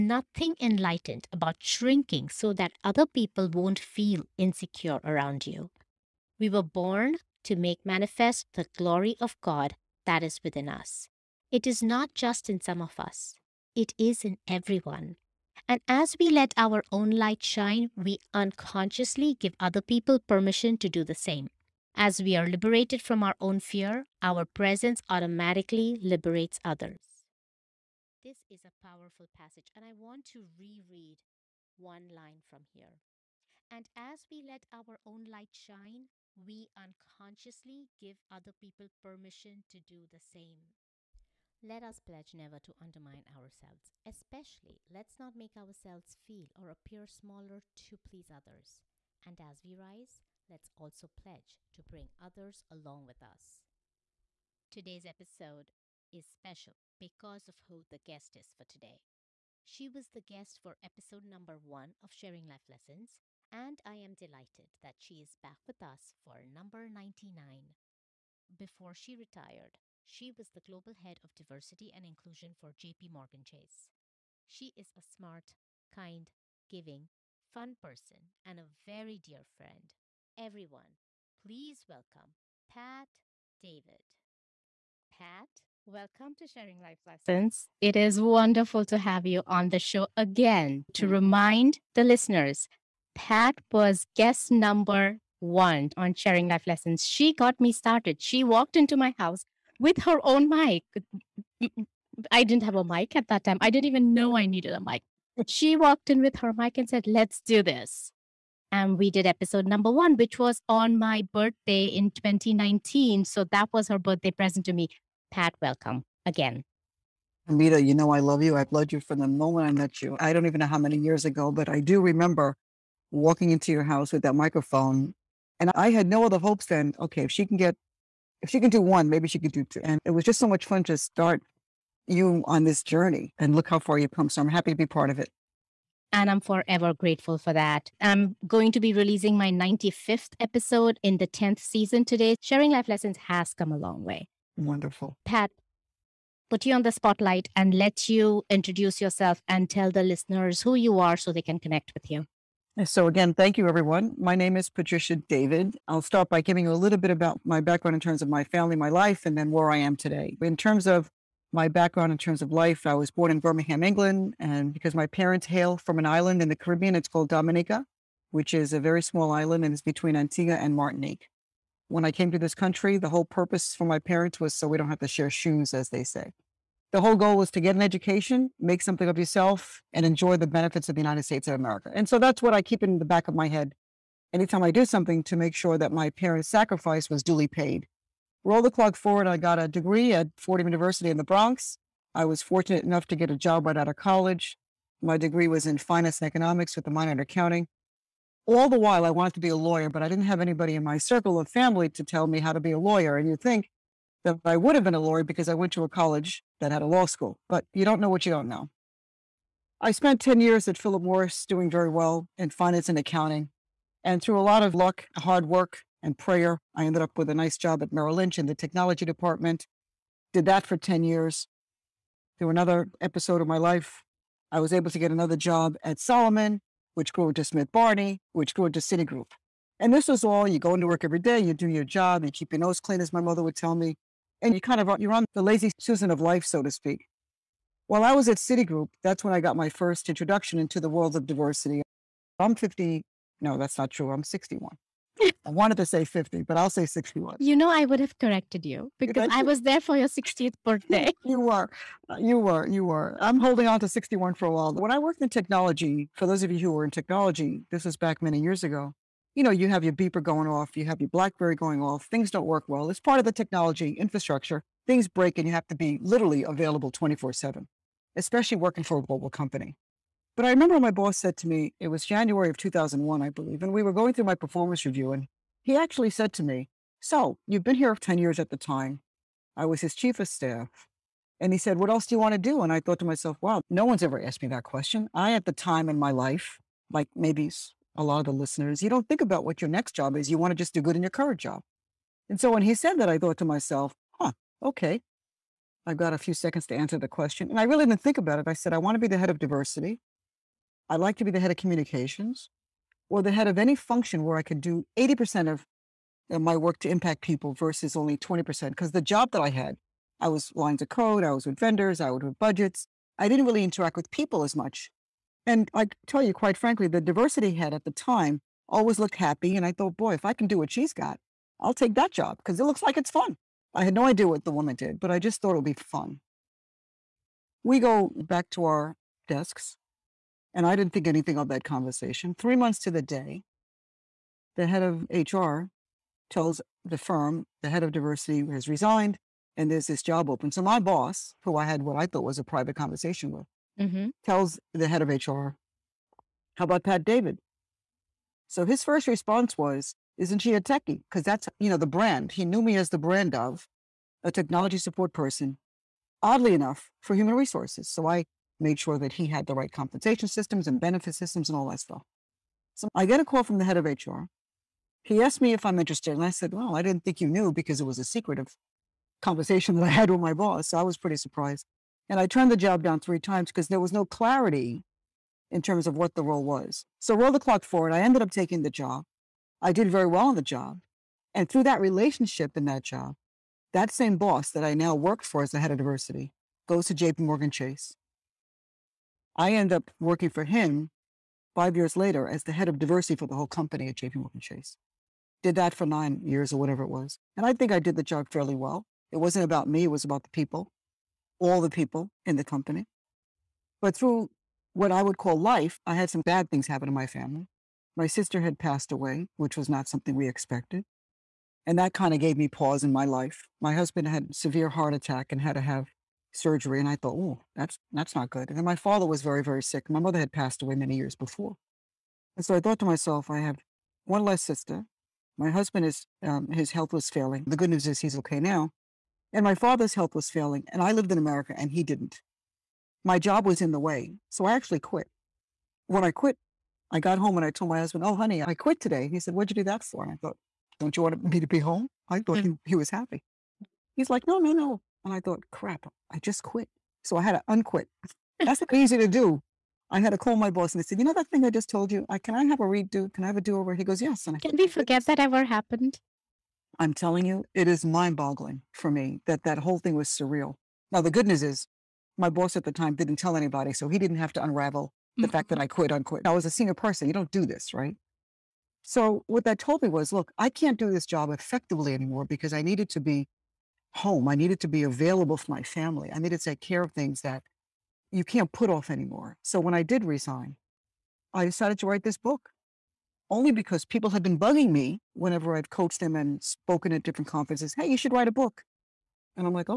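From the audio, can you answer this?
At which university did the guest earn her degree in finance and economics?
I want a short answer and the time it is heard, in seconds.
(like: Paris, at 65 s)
Fordham University, at 190 s.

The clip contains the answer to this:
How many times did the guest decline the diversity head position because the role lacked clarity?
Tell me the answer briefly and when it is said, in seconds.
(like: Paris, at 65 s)
3, at 372 s.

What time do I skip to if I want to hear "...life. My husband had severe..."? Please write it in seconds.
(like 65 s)
413 s.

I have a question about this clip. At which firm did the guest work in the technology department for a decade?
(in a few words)
Merrill Lynch.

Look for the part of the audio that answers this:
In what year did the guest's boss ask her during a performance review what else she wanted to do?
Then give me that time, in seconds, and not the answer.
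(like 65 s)
272 s.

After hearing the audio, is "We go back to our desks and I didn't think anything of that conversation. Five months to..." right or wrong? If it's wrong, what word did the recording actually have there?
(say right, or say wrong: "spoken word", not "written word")
wrong: "Three", not "Five".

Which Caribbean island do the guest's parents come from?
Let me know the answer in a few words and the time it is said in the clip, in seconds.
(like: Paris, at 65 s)
Dominica, at 167 s.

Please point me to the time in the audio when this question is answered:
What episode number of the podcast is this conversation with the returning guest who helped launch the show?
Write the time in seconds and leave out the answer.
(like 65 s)
66 s.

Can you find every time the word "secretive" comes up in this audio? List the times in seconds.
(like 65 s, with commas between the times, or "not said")
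368 s.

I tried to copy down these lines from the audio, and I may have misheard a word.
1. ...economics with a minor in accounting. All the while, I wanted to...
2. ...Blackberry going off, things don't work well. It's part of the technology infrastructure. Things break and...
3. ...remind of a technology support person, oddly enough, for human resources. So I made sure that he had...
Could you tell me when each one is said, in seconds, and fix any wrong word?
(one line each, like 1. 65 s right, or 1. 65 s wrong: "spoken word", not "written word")
1. 196 s right
2. 261 s right
3. 352 s wrong: "brand", not "remind".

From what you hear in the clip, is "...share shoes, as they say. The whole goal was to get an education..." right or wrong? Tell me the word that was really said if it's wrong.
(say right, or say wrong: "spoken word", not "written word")
right.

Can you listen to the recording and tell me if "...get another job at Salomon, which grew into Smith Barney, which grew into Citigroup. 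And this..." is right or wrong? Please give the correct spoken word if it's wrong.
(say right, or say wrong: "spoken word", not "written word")
right.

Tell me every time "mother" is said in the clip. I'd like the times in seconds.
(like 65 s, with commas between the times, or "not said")
233 s, 419 s.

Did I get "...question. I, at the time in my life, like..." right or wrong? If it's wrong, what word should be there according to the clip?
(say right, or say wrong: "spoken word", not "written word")
right.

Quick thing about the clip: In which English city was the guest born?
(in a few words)
Birmingham.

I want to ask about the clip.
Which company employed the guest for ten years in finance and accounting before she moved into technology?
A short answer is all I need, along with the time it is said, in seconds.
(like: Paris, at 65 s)
Philip Morris, at 210 s.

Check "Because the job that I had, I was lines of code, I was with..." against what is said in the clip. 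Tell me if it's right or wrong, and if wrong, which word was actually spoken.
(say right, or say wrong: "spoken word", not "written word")
right.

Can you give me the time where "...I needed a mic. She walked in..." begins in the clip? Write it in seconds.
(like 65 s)
104 s.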